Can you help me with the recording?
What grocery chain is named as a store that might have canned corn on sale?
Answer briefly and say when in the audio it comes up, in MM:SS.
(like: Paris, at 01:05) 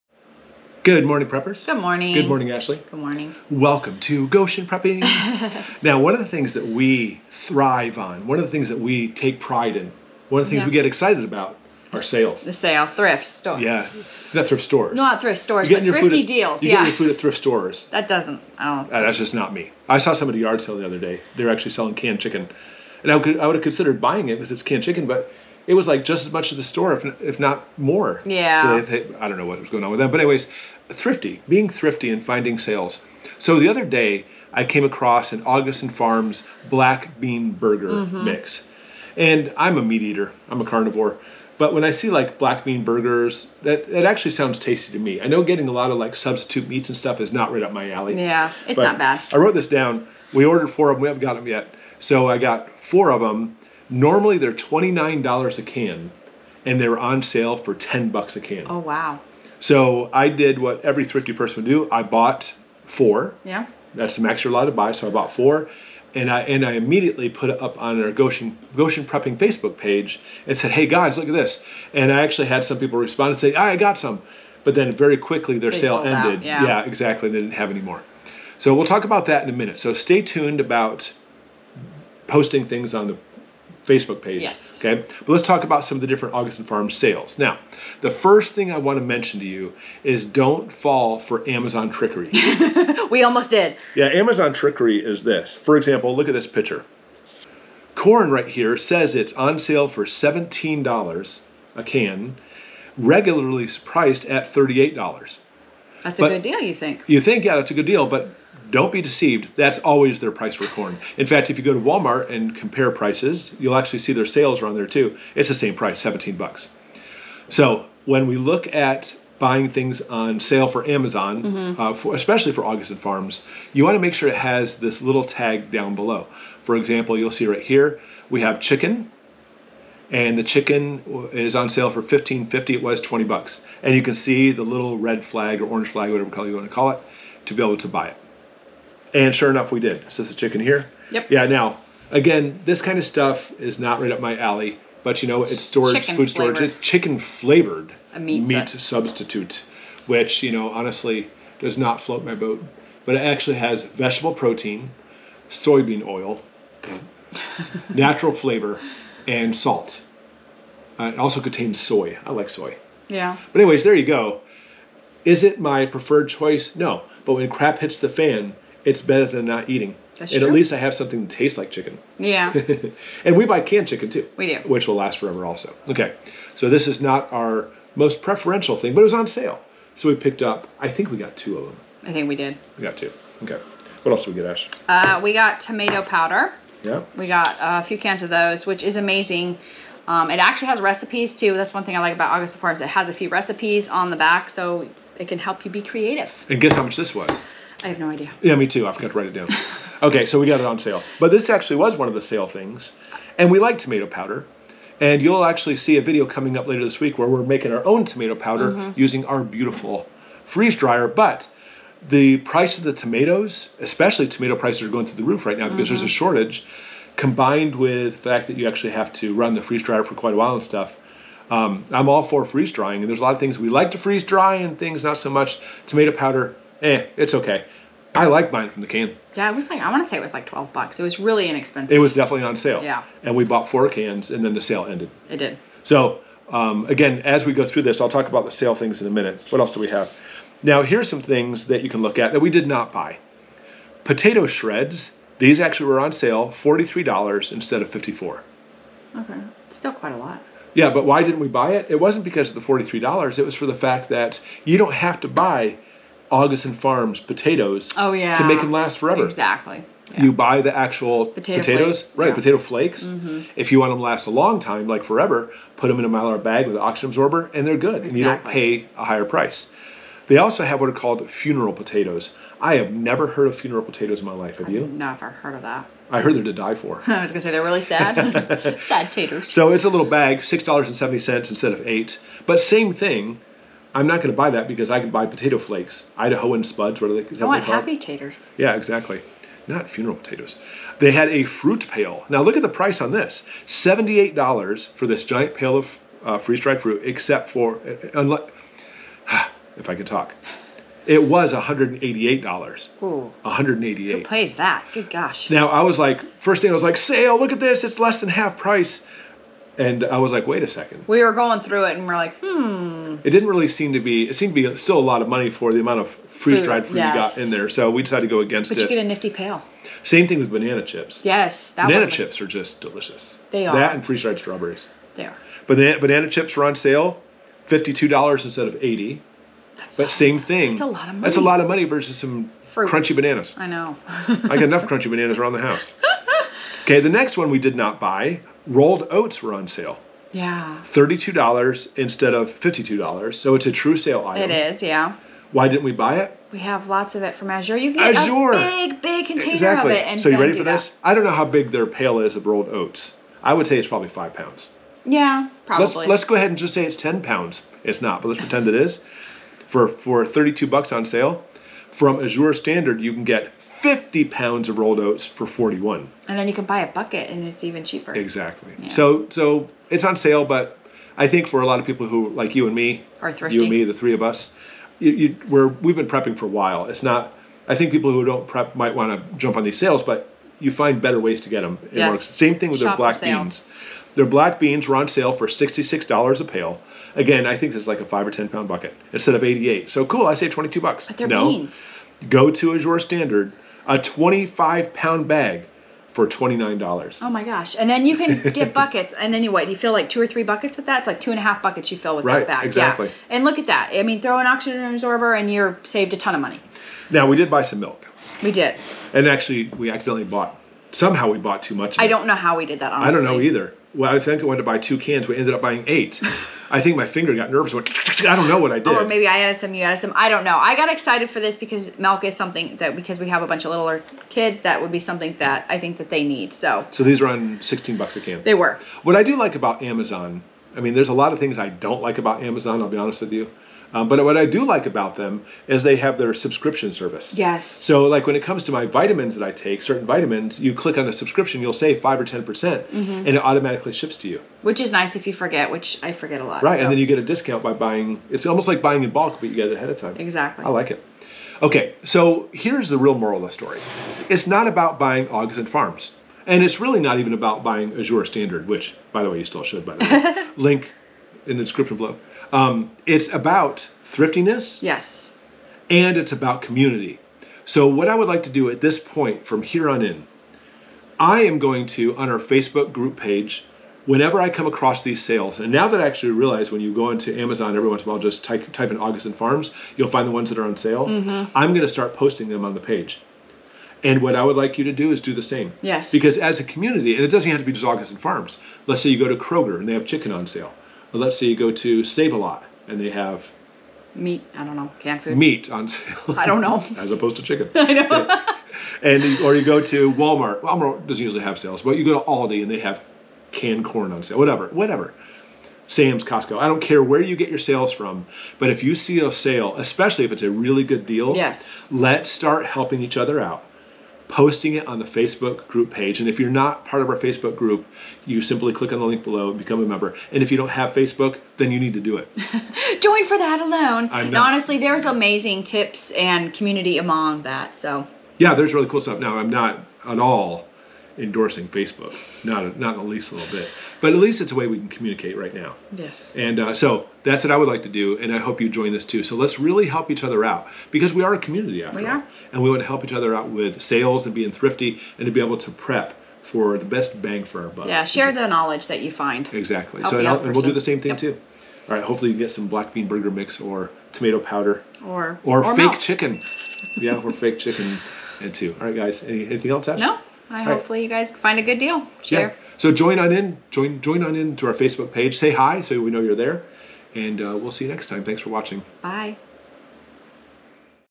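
Aldi, at 08:22.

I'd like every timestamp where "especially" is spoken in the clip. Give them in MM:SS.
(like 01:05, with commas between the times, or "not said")
02:02, 03:33, 08:29.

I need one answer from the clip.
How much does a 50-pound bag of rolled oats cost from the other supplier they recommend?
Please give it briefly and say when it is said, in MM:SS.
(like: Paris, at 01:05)
$41, at 06:05.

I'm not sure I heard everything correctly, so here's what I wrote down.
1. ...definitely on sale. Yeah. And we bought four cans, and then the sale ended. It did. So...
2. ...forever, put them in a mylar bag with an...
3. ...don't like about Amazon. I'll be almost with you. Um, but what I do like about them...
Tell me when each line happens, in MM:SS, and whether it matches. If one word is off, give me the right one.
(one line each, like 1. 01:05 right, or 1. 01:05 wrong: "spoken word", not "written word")
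1. 03:52 right
2. 04:25 right
3. 07:11 wrong: "honest", not "almost".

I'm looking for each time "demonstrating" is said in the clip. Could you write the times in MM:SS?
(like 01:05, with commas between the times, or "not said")
not said.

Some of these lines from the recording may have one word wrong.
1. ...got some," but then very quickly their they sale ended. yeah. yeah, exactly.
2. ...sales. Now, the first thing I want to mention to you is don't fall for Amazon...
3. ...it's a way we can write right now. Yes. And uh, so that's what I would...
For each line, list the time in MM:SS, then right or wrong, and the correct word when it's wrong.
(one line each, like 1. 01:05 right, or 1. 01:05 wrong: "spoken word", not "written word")
1. 01:13 right
2. 01:26 right
3. 08:54 wrong: "communicate", not "write".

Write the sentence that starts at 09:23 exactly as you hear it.
Join join on in to our Facebook page.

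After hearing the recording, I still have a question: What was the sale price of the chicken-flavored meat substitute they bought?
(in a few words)
$15.50.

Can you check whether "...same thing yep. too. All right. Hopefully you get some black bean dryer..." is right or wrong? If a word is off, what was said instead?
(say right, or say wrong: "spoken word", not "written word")
wrong: "burger", not "dryer".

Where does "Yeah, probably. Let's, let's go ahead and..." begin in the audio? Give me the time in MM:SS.
05:55.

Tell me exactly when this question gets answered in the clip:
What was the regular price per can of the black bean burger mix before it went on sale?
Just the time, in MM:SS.
00:54.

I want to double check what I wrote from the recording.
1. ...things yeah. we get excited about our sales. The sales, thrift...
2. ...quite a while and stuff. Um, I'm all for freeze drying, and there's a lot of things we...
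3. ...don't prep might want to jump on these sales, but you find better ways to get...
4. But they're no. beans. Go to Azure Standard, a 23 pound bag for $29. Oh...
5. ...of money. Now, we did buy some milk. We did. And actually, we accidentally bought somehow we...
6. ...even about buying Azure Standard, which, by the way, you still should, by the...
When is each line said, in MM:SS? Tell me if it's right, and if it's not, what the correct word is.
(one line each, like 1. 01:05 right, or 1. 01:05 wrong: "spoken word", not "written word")
1. 00:10 right
2. 03:40 right
3. 06:18 right
4. 06:31 wrong: "25", not "23"
5. 06:46 right
6. 07:37 right.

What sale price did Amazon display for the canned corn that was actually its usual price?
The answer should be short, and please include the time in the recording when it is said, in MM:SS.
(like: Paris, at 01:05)
$17, at 01:40.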